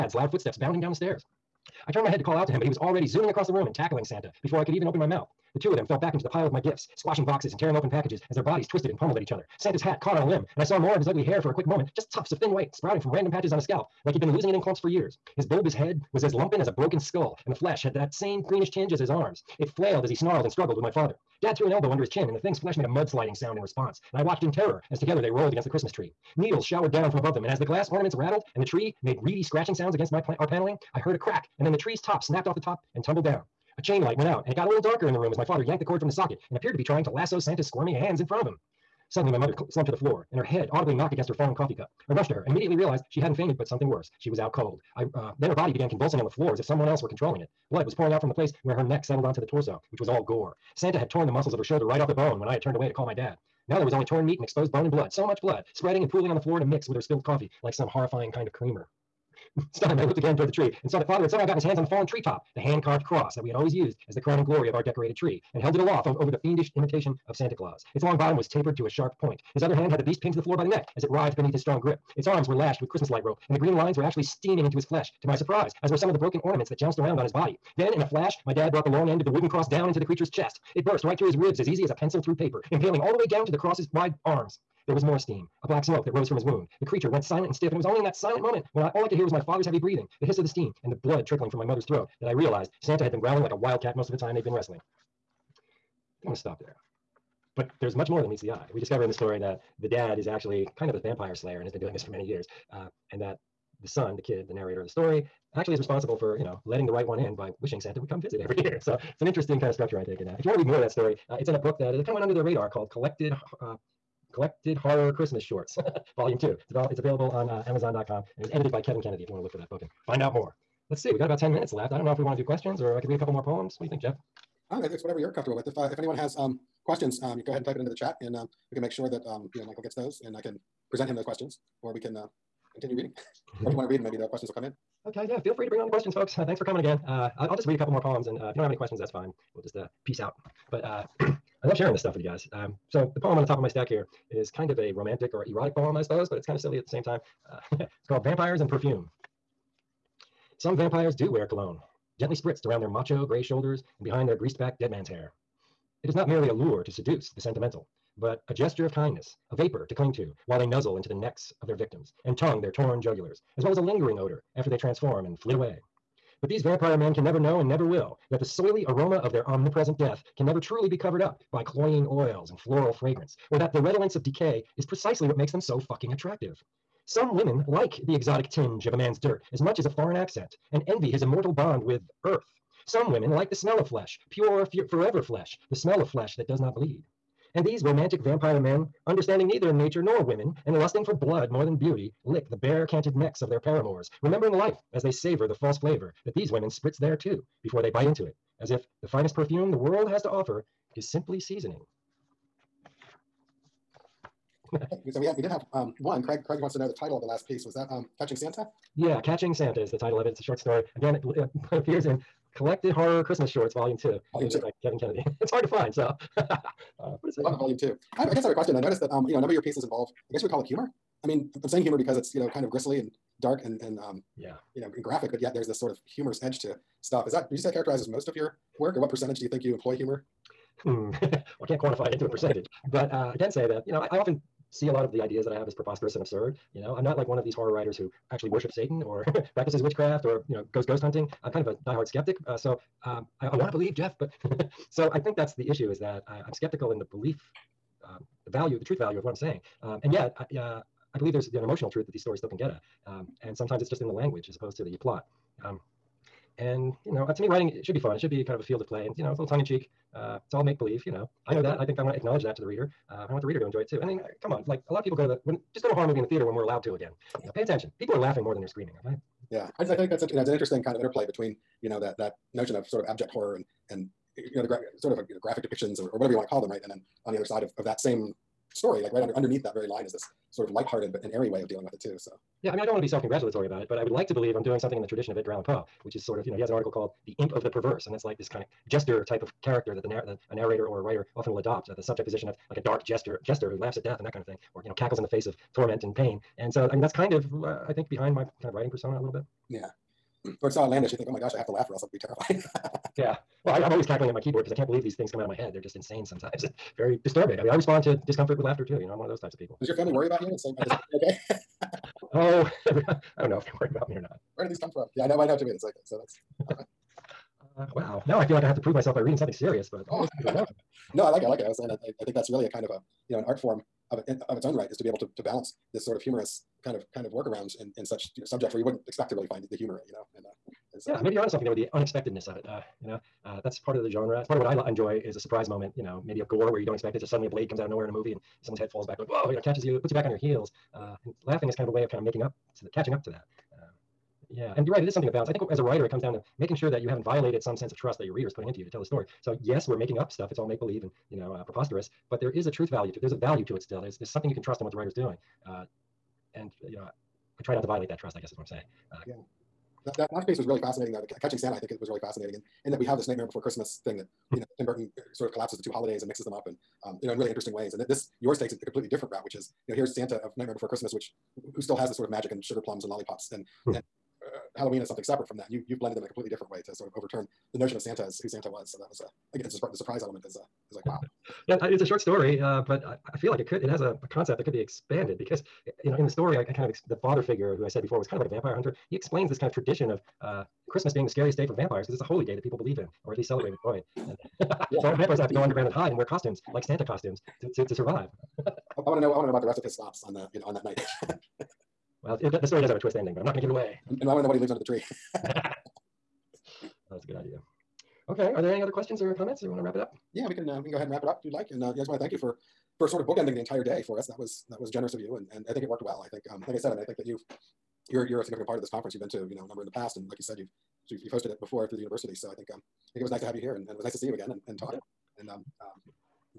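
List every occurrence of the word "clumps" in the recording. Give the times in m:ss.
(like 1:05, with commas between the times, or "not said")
0:14.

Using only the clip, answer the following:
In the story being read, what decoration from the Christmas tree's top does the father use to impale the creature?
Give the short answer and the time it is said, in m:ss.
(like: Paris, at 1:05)
hand carved cross, at 1:02.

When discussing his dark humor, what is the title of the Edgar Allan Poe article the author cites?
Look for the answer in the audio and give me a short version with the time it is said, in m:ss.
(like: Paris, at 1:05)
The Imp of the Perverse, at 4:47.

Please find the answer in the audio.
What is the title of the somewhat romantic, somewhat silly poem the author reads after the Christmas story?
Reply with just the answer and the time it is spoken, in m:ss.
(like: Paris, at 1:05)
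Vampires and Perfume, at 2:28.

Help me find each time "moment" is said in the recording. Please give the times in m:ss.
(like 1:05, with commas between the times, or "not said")
0:11, 1:28, 5:35.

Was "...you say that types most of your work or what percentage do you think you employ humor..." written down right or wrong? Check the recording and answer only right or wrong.
wrong.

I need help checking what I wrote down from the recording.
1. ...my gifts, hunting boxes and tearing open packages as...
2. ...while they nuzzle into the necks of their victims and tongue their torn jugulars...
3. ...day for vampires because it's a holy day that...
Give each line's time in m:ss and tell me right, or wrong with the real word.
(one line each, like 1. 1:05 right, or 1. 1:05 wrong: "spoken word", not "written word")
1. 0:06 wrong: "squashing", not "hunting"
2. 2:40 right
3. 6:31 right.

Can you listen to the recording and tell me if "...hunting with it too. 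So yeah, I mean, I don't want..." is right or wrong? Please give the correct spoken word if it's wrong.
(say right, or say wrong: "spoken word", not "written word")
wrong: "dealing", not "hunting".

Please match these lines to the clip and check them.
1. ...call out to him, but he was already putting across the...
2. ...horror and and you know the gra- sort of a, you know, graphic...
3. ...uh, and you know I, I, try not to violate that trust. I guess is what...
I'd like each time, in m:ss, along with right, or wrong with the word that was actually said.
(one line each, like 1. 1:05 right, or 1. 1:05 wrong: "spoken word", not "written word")
1. 0:02 wrong: "zooming", not "putting"
2. 4:33 right
3. 5:55 right.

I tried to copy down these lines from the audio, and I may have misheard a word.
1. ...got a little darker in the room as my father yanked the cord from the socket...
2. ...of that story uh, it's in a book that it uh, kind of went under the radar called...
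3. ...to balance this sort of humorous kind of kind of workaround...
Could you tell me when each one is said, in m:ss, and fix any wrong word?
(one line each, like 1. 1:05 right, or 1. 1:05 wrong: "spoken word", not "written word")
1. 0:34 right
2. 1:50 right
3. 5:25 right.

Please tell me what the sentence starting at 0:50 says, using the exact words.
Santa had torn the muscles of her shoulder right off the bone when I had turned away to call my dad.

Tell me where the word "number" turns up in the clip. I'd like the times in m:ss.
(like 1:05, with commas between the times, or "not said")
3:39, 6:59.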